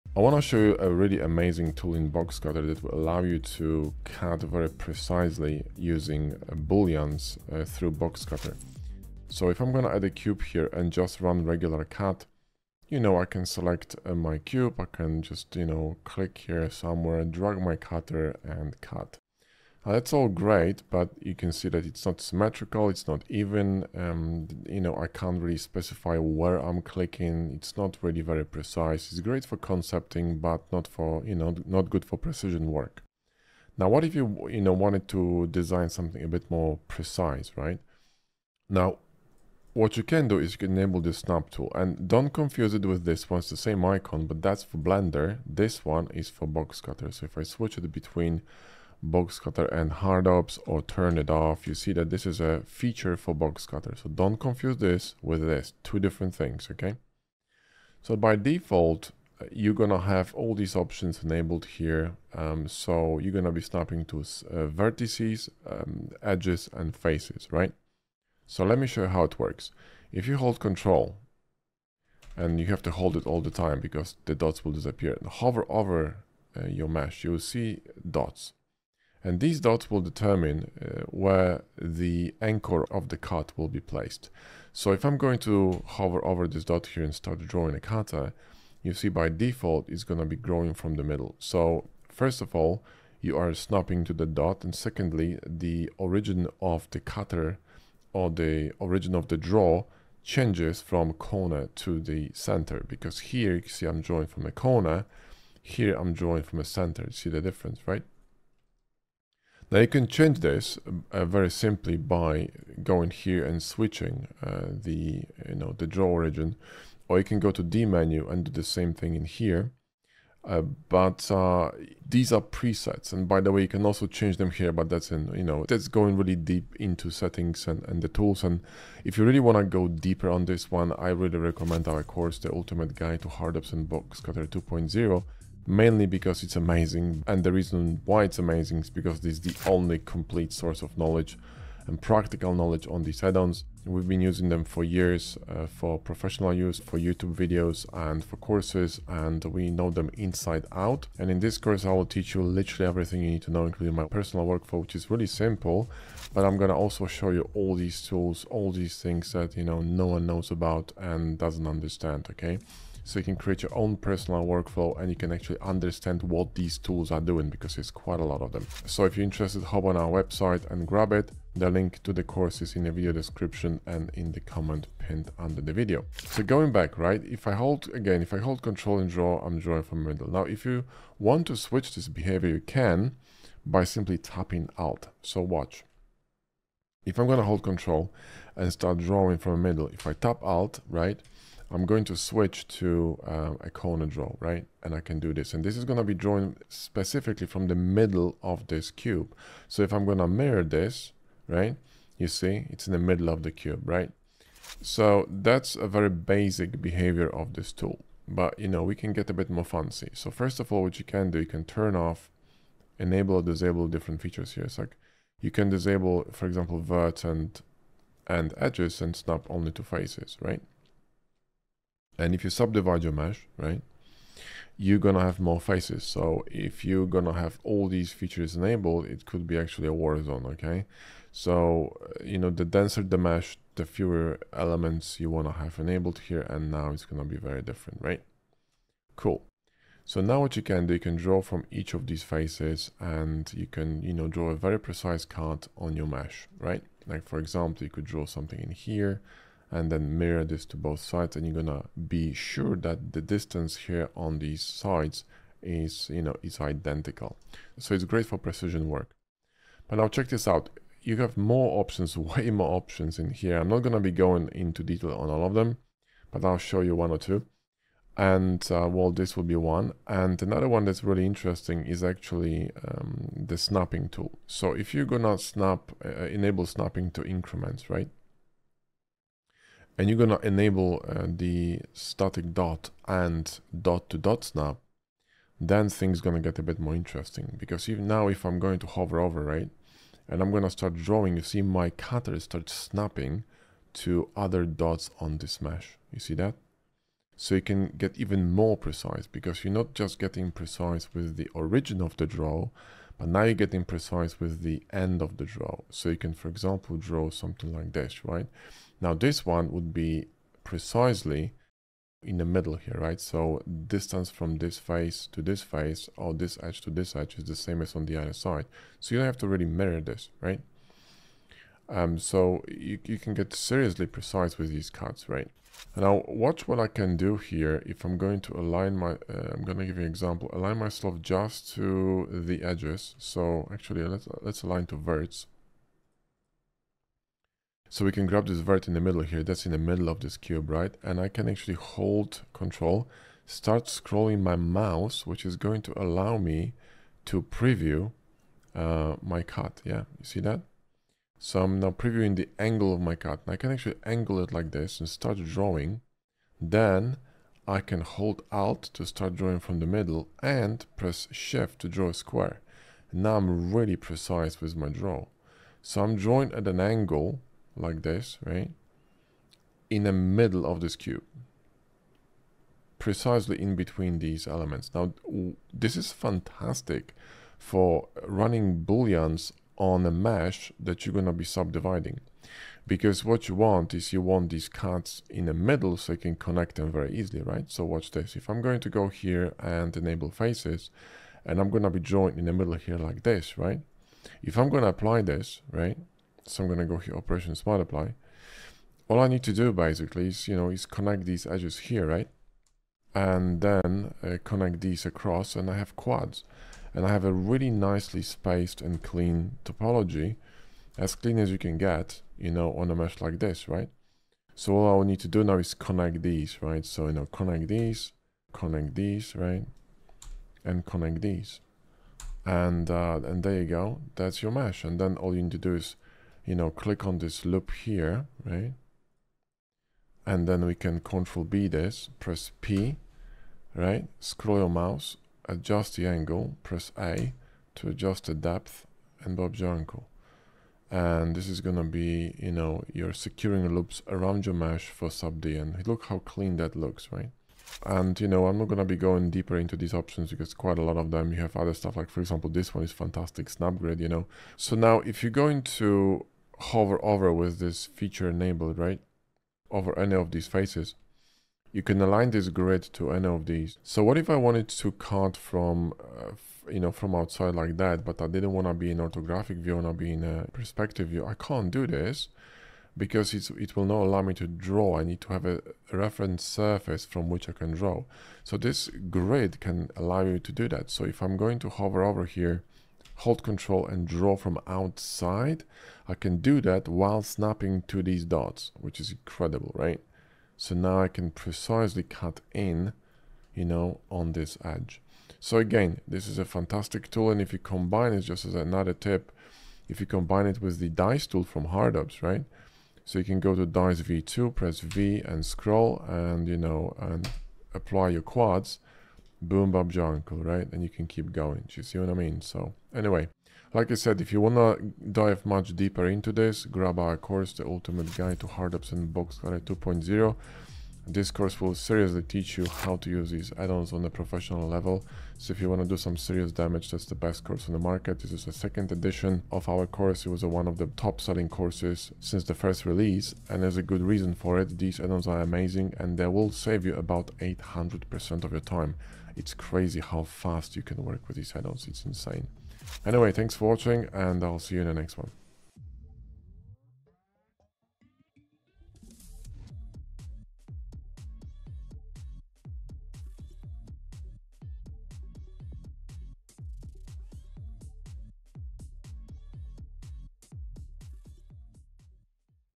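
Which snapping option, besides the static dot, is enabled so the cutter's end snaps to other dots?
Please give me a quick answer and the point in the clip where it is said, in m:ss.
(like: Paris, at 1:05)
dot to dot snap, at 4:43.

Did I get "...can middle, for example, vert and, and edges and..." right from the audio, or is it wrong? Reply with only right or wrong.
wrong.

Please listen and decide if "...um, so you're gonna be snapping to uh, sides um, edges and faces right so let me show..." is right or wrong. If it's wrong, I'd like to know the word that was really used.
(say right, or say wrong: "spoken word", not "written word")
wrong: "vertices", not "sides".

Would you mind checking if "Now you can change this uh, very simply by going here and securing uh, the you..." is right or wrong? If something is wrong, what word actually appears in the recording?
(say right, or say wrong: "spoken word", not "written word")
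wrong: "switching", not "securing".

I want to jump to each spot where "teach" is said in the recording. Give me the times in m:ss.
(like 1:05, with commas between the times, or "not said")
2:32, 8:42.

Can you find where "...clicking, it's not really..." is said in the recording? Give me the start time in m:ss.
0:26.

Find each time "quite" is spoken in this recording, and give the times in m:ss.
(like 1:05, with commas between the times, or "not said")
2:47, 7:30.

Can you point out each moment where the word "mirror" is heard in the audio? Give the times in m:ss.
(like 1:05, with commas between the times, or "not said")
3:20, 4:10, 5:19.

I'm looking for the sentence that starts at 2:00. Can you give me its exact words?
Uh, but uh, these are presets, and by the way, you can also change them here.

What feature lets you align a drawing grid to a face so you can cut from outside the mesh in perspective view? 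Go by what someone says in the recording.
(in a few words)
snapgrid.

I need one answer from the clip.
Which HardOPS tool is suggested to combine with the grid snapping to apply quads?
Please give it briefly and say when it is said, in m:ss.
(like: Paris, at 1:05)
dice V2, at 8:23.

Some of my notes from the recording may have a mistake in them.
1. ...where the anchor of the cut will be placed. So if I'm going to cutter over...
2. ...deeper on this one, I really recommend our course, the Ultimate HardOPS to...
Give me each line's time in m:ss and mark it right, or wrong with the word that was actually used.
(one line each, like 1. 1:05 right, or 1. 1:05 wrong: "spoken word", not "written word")
1. 1:21 wrong: "hover", not "cutter"
2. 2:09 wrong: "Guide", not "HardOPS".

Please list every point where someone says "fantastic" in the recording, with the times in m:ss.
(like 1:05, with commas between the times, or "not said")
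6:16, 7:32, 8:16.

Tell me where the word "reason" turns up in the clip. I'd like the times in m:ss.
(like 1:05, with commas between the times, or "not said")
2:17, 8:54.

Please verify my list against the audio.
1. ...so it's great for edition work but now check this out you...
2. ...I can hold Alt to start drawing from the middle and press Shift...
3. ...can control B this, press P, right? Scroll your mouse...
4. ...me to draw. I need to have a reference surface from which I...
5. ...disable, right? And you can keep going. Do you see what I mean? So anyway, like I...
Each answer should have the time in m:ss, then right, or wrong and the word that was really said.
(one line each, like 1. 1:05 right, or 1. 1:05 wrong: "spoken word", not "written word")
1. 4:17 wrong: "precision", not "edition"
2. 5:57 right
3. 7:10 right
4. 7:54 right
5. 8:29 wrong: "uncle", not "disable".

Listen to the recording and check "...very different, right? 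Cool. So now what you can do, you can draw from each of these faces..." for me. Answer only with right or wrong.
right.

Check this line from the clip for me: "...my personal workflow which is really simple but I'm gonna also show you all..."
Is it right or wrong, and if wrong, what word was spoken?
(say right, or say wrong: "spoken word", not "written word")
right.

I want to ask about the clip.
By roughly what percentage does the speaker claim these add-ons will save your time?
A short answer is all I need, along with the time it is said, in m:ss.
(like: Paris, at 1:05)
800%, at 8:57.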